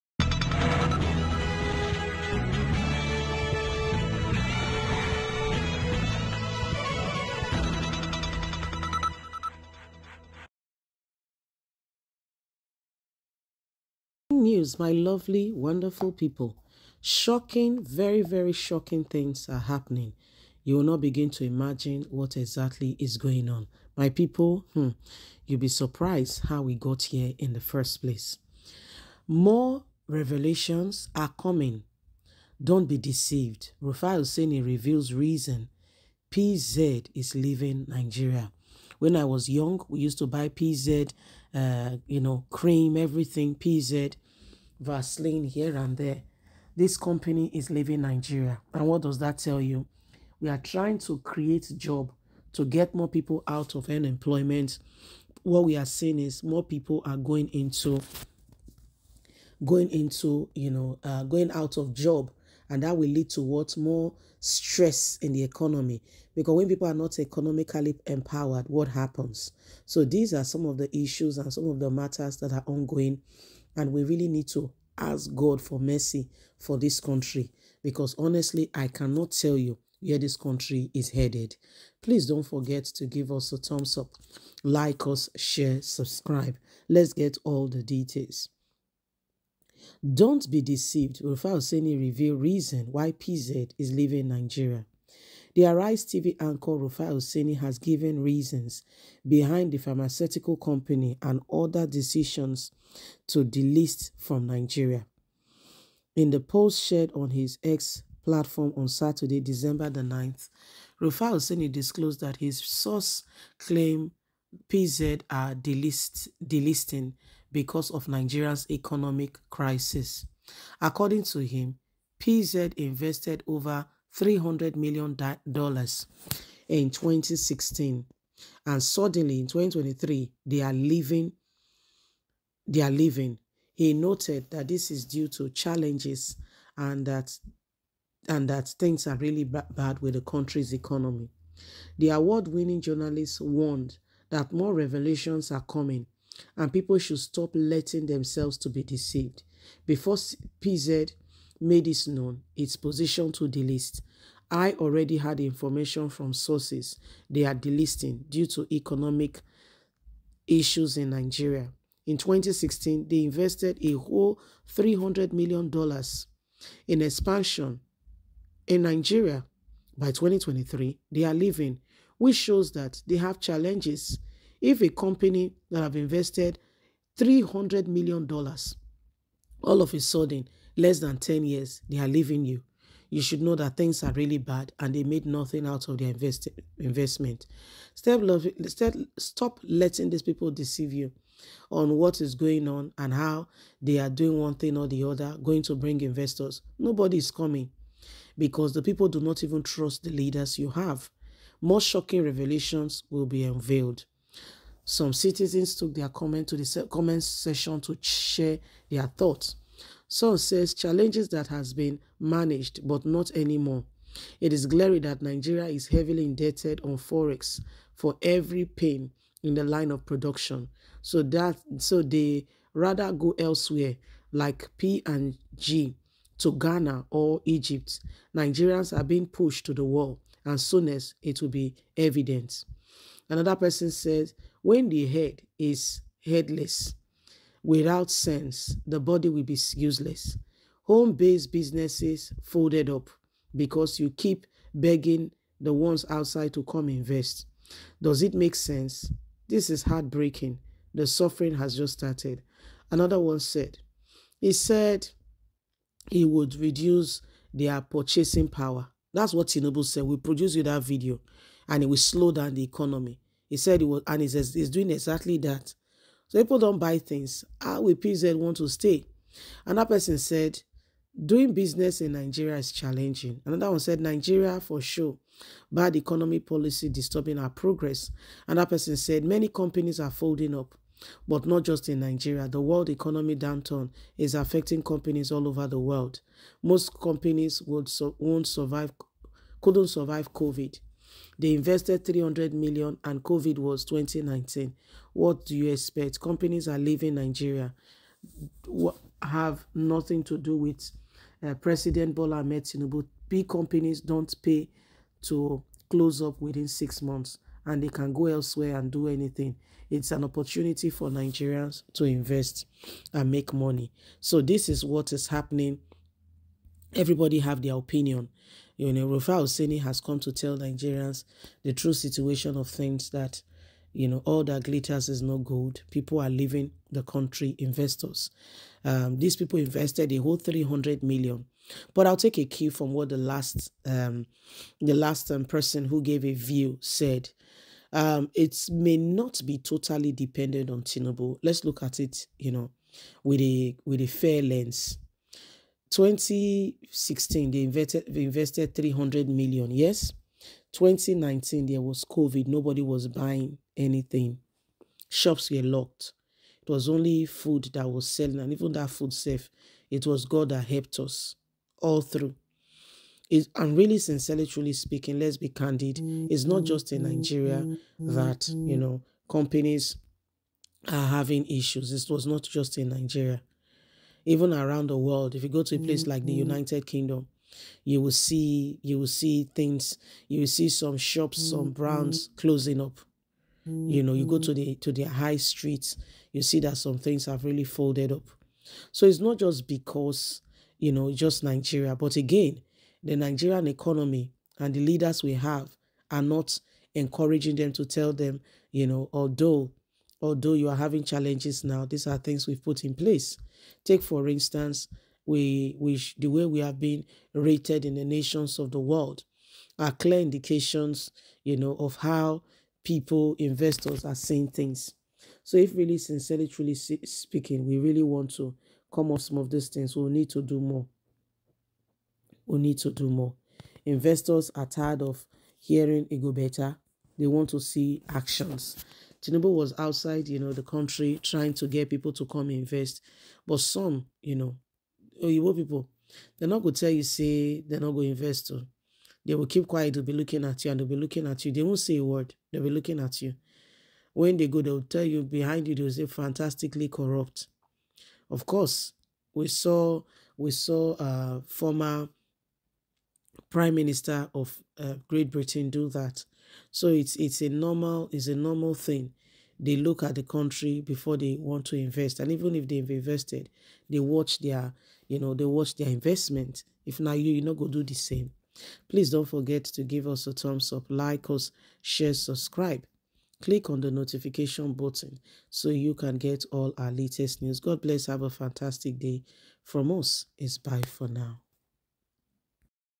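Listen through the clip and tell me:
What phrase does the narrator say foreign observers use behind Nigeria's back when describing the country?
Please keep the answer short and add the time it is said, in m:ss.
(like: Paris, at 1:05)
fantastically corrupt, at 7:26.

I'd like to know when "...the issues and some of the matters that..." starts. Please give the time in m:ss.
1:10.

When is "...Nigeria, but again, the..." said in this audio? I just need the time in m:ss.
6:31.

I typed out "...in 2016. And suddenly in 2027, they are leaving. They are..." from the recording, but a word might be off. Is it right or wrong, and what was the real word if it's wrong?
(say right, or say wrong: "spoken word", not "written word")
wrong: "2023", not "2027".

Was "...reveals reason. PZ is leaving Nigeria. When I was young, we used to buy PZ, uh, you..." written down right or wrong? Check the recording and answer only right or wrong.
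right.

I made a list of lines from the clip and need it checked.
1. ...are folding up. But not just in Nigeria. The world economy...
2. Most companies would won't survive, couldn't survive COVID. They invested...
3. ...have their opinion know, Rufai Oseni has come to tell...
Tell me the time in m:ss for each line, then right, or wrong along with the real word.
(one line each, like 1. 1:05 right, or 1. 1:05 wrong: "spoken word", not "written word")
1. 4:39 right
2. 4:46 right
3. 5:17 right.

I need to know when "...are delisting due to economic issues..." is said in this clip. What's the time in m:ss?
2:37.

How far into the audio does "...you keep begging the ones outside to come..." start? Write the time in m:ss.
4:03.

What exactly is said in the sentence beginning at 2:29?
Before PZ made it known its position to delist.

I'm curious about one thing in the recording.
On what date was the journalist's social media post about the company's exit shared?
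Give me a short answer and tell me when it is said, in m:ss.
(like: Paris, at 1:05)
December 9, at 1:49.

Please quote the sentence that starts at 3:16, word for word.
Nobody is coming because the people do not even trust the leaders you have.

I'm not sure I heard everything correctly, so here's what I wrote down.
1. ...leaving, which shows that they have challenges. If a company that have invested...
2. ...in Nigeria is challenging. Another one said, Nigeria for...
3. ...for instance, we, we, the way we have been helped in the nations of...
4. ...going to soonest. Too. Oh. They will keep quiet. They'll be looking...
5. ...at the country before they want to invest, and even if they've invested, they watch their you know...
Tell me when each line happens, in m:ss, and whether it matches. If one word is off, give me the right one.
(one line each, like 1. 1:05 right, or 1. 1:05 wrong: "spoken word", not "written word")
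1. 2:51 right
2. 4:31 right
3. 6:44 wrong: "rated", not "helped"
4. 7:17 wrong: "invest", not "soonest"
5. 7:40 right.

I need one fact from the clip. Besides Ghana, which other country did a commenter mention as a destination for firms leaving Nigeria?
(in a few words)
Egypt.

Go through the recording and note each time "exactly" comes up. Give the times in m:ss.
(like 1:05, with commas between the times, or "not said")
0:22, 4:24.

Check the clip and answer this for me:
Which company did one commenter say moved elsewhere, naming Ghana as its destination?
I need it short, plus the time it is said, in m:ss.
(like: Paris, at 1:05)
P and G, at 3:44.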